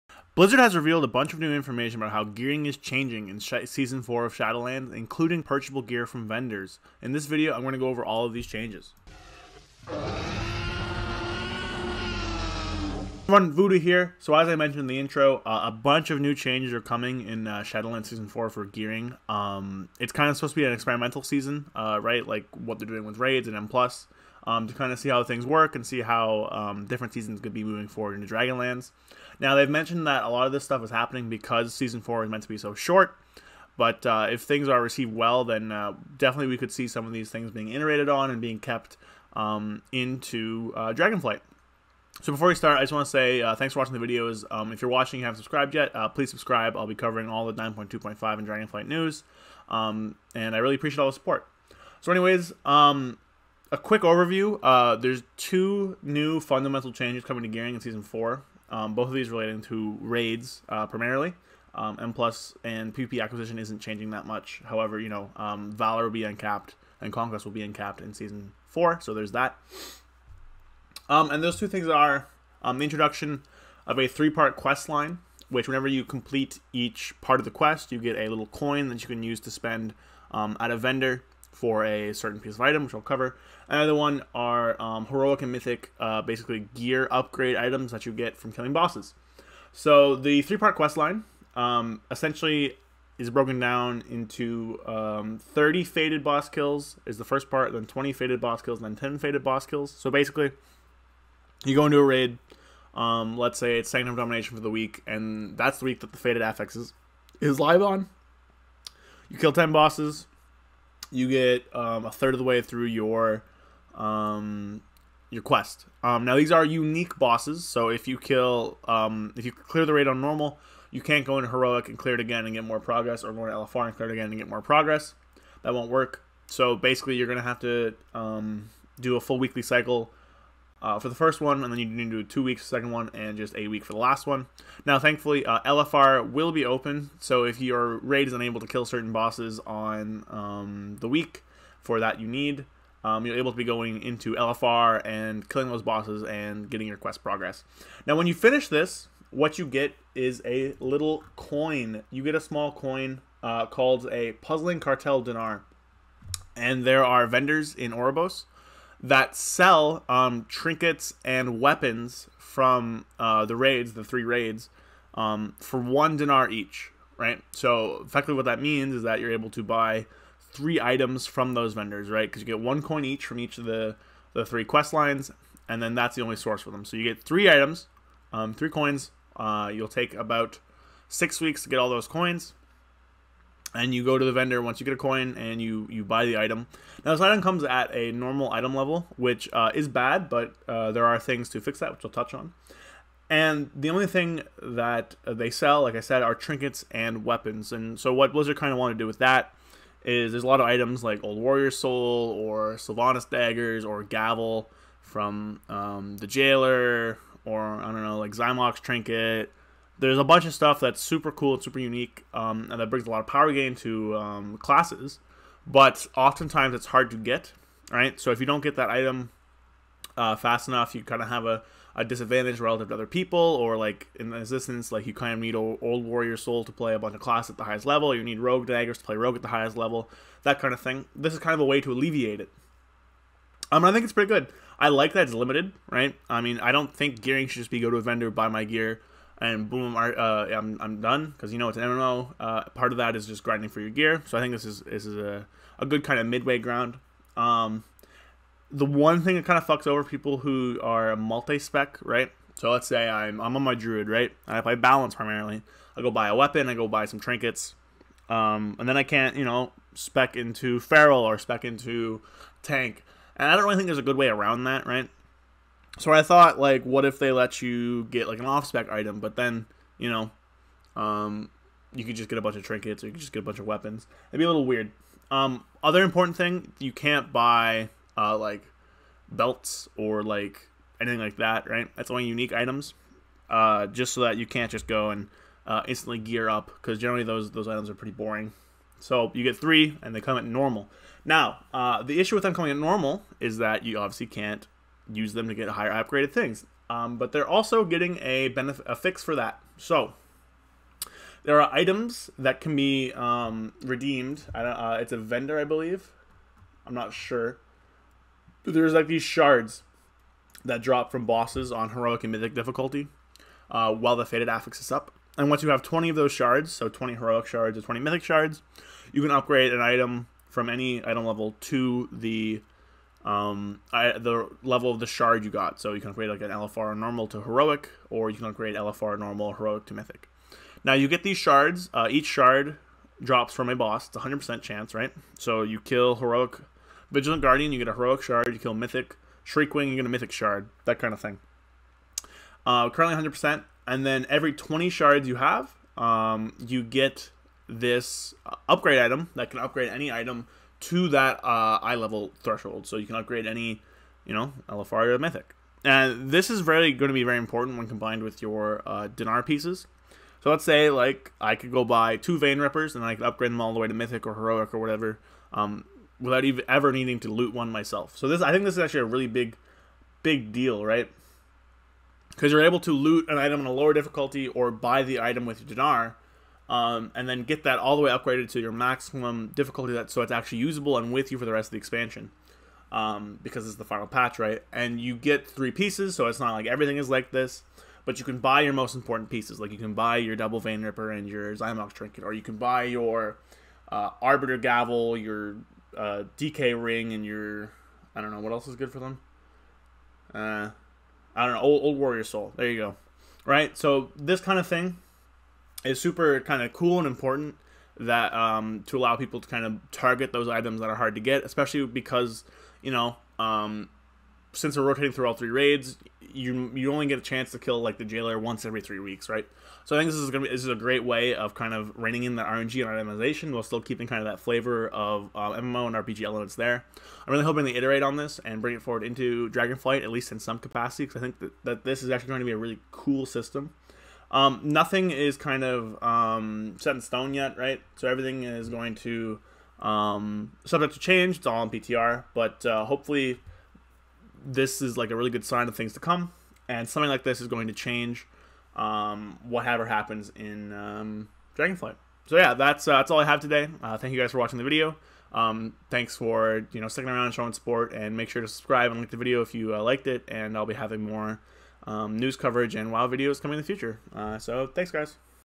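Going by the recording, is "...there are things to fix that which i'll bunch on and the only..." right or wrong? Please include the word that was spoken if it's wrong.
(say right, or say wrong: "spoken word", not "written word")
wrong: "touch", not "bunch".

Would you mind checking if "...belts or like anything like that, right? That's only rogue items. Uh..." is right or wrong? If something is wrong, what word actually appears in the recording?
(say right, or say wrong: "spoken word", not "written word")
wrong: "unique", not "rogue".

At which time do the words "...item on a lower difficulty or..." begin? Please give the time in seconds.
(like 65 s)
373 s.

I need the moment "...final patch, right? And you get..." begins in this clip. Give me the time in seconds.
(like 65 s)
383 s.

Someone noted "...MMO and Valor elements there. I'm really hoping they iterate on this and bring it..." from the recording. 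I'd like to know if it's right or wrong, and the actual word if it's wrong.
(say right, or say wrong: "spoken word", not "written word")
wrong: "RPG", not "Valor".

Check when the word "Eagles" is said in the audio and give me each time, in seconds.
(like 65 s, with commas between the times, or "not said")
not said.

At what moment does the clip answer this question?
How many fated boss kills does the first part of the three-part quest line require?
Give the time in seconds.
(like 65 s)
95 s.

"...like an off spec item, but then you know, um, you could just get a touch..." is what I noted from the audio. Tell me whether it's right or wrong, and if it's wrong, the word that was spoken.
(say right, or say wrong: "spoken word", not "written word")
wrong: "bunch", not "touch".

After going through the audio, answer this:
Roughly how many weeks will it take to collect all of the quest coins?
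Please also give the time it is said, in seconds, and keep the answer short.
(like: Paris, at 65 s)
6, at 181 s.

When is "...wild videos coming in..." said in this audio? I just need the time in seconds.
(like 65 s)
462 s.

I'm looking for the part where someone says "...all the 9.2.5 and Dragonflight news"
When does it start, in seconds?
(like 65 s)
47 s.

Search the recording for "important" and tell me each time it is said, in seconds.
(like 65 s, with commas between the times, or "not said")
276 s, 357 s, 388 s, 407 s.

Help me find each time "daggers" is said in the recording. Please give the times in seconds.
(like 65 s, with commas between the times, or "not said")
203 s, 228 s.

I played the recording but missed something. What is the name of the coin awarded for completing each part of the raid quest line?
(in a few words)
Puzzling Cartel Dinar.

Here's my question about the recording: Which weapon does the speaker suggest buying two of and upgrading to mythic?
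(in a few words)
Vein Ripper.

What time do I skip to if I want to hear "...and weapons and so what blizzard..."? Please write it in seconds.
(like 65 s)
196 s.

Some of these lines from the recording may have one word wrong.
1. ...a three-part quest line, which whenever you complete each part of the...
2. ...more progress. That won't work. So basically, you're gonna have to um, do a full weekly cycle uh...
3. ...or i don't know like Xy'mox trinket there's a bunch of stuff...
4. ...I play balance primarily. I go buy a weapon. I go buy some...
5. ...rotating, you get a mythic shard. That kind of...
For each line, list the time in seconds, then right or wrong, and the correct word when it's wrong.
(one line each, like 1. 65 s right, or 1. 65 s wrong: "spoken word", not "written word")
1. 73 s right
2. 124 s right
3. 207 s right
4. 254 s right
5. 339 s wrong: "shriekwing", not "rotating".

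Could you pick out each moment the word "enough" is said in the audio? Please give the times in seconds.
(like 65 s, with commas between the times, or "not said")
220 s.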